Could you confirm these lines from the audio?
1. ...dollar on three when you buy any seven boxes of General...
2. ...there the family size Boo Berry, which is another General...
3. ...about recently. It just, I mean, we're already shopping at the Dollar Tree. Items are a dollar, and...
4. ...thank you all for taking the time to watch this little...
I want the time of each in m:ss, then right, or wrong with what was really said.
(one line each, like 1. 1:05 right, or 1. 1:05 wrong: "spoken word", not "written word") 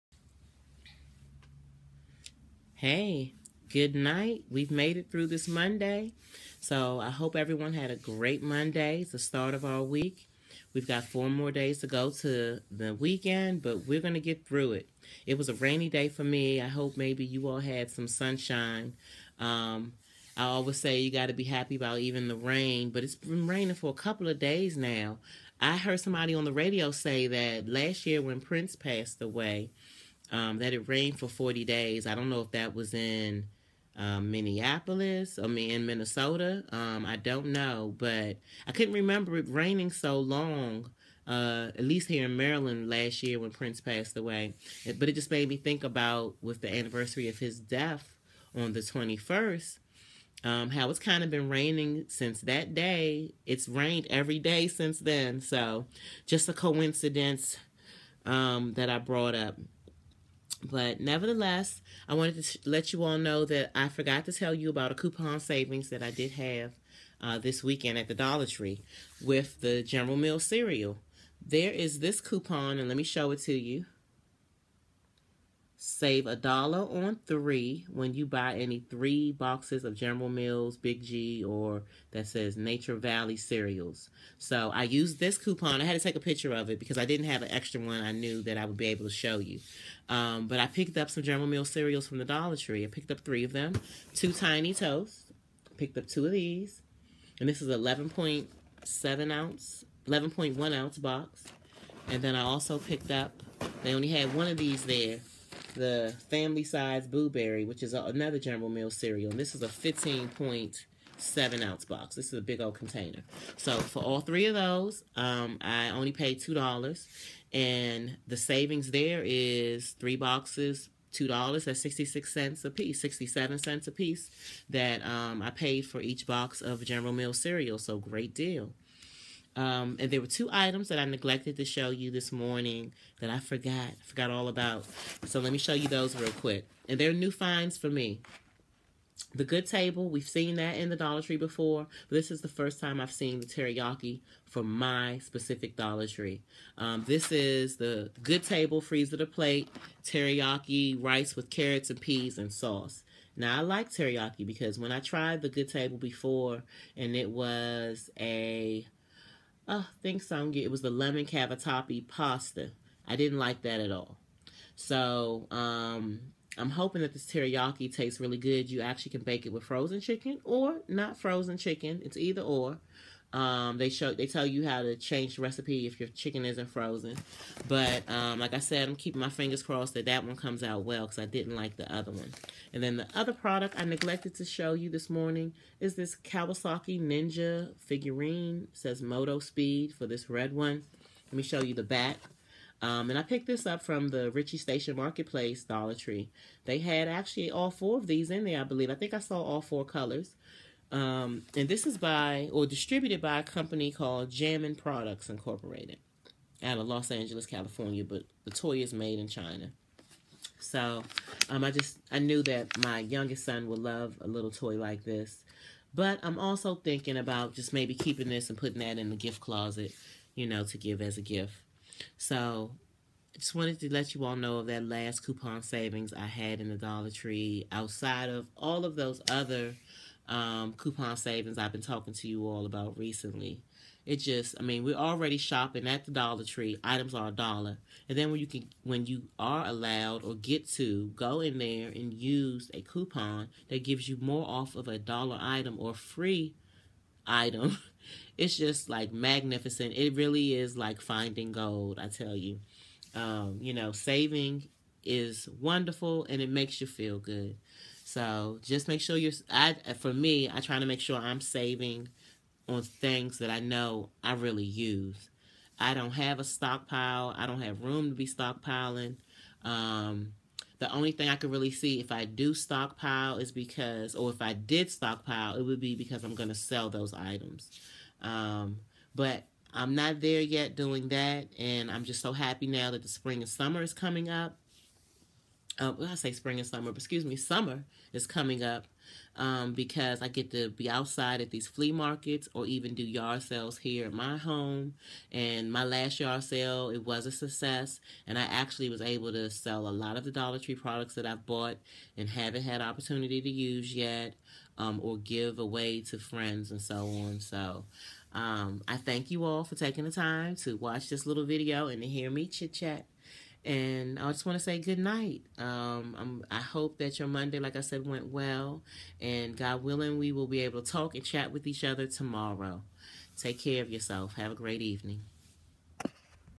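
1. 1:16 wrong: "three", not "seven"
2. 1:44 right
3. 3:52 right
4. 5:08 right.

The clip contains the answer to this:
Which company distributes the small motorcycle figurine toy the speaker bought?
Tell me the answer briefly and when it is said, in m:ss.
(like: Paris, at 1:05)
Jammin Products Incorporated, at 3:24.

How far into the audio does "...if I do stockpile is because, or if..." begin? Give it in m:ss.
4:32.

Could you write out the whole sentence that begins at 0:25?
I heard somebody on the radio say that last year when Prince passed away, um, that it rained for 40 days.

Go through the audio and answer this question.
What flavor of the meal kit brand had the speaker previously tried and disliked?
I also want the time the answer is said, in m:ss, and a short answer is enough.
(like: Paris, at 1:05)
lemon cavatappi, at 2:40.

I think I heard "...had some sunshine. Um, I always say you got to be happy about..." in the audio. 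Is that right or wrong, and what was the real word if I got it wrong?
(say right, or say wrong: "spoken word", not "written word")
right.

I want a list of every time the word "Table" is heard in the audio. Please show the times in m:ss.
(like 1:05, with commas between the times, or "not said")
2:19, 2:28, 2:35.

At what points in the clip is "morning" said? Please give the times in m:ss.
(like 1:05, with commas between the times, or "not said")
2:12, 3:05.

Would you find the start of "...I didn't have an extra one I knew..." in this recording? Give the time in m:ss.
1:26.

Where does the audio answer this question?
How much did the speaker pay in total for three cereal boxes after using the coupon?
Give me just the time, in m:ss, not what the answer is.
1:56.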